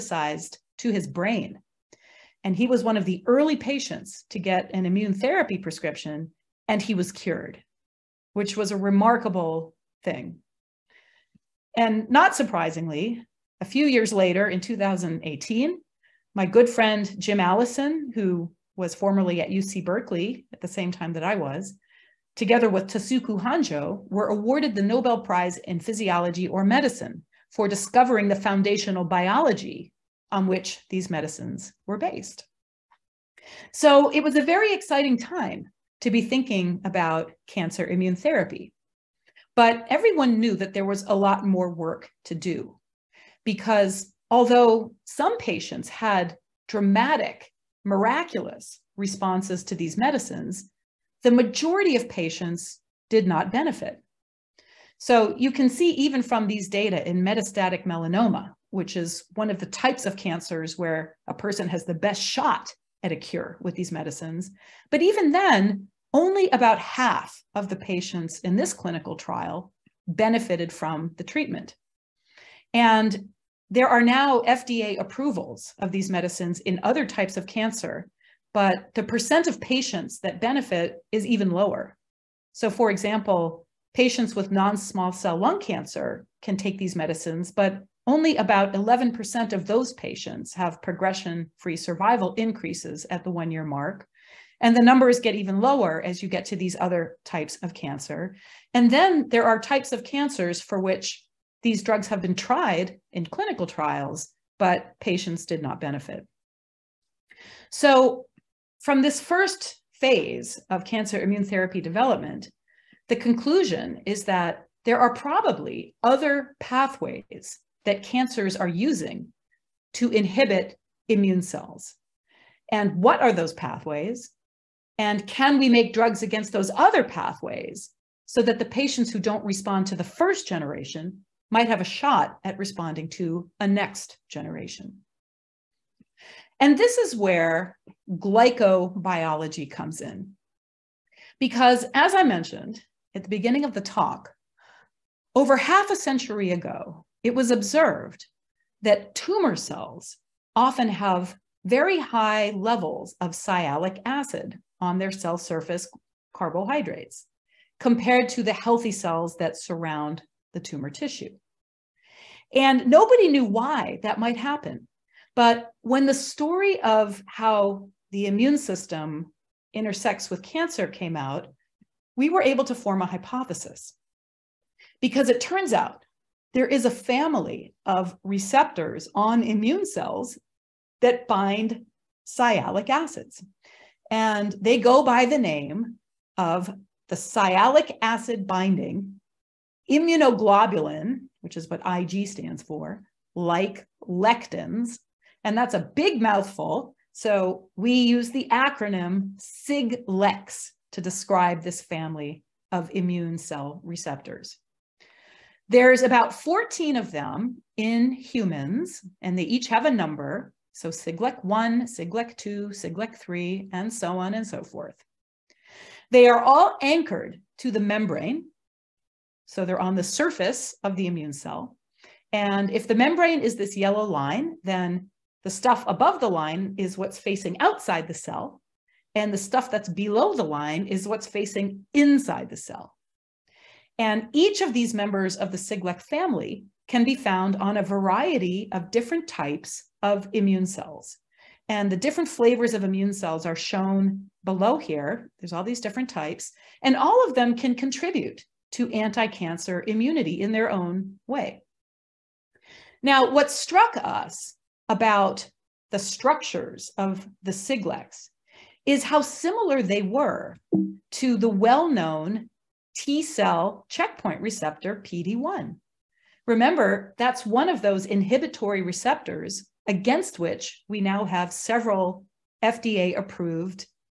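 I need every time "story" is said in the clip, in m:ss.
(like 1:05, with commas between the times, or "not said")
2:46.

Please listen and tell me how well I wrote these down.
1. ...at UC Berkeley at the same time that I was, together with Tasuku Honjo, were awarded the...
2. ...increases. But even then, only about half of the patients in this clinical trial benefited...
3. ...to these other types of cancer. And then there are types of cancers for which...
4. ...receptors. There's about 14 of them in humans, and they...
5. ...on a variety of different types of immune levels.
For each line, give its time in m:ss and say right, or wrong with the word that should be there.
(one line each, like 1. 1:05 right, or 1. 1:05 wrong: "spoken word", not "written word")
1. 0:19 right
2. 1:03 wrong: "medicines", not "increases"
3. 1:36 right
4. 3:23 right
5. 3:57 wrong: "cells", not "levels".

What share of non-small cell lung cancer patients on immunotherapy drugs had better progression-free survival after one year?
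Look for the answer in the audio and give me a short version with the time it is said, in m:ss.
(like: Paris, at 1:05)
11%, at 1:28.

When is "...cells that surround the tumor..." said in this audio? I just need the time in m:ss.
2:38.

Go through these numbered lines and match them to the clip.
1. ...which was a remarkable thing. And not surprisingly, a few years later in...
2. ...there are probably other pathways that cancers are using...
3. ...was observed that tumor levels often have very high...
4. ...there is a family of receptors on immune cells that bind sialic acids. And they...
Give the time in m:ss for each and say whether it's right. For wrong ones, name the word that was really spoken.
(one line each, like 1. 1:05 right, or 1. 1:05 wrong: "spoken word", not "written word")
1. 0:08 right
2. 1:54 right
3. 2:27 wrong: "cells", not "levels"
4. 2:56 right.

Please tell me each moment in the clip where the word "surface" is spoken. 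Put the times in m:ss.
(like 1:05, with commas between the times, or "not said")
2:35, 3:40.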